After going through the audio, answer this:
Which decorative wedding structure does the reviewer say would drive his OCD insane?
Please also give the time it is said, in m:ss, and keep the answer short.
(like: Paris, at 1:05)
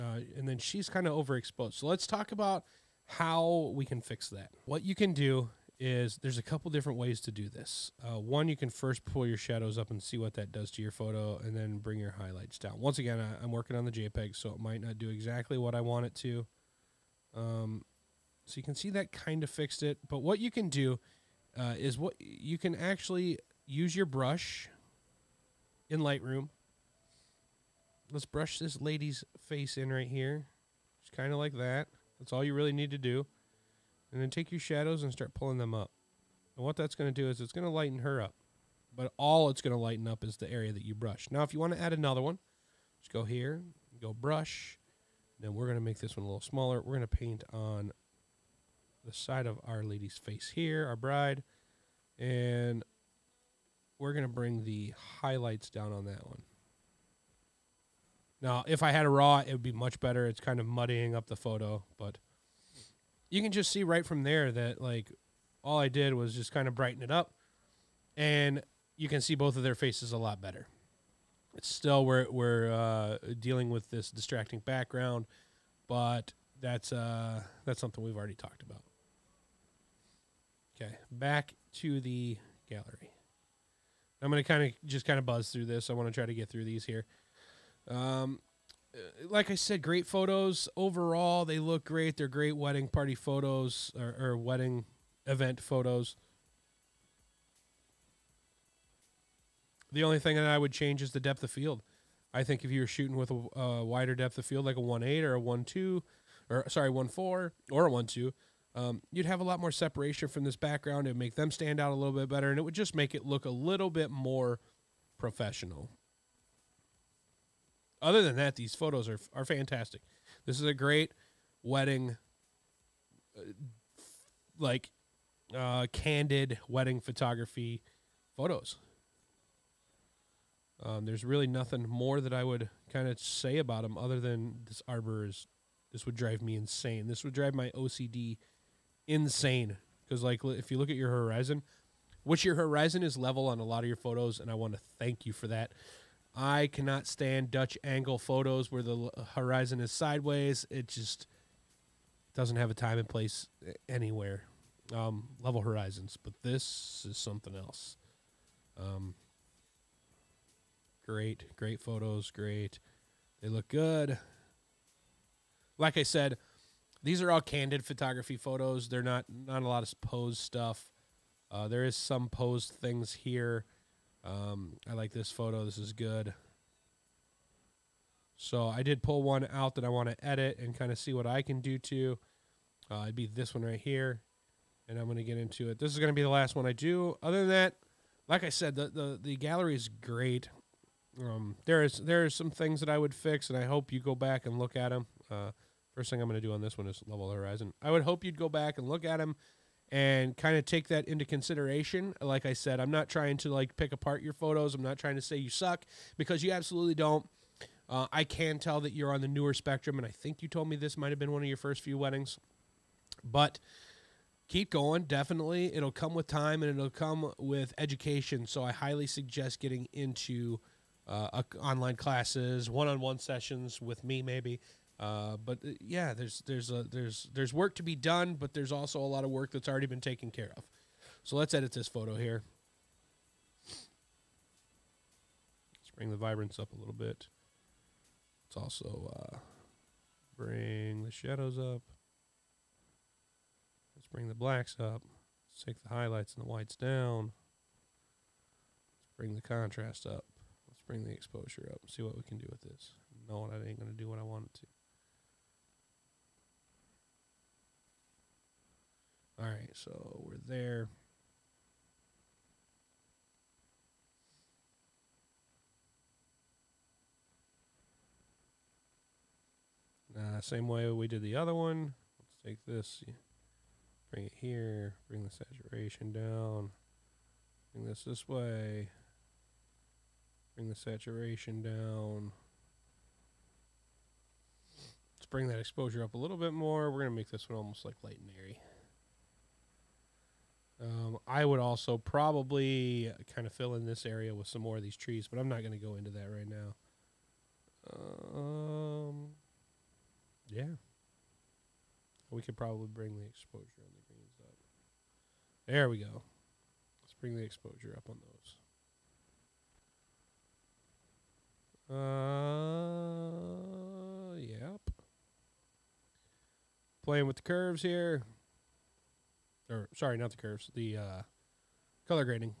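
Arbor, at 2:14.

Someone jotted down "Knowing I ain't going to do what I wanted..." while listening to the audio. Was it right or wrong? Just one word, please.
right.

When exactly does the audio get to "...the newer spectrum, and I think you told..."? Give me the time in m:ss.
3:29.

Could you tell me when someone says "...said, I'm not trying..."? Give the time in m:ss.
3:22.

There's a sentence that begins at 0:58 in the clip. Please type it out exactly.
Now, if I had a raw, it would be much better.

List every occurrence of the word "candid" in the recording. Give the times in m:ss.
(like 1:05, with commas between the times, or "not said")
2:05, 2:47.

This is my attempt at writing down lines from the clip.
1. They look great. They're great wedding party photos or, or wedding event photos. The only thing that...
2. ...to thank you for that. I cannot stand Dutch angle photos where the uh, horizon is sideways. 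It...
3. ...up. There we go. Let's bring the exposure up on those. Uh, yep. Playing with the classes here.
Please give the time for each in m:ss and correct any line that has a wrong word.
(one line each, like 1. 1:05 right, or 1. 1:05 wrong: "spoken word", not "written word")
1. 1:31 right
2. 2:24 right
3. 5:04 wrong: "curves", not "classes".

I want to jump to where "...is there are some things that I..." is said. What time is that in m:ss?
3:11.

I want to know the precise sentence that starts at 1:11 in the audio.
It's still we're we're uh, dealing with this distracting background, but that's uh, that's something we've already talked about.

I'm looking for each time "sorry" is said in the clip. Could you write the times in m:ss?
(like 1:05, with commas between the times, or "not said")
1:46, 5:19.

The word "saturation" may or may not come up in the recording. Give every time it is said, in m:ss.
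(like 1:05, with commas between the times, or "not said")
4:35, 4:40.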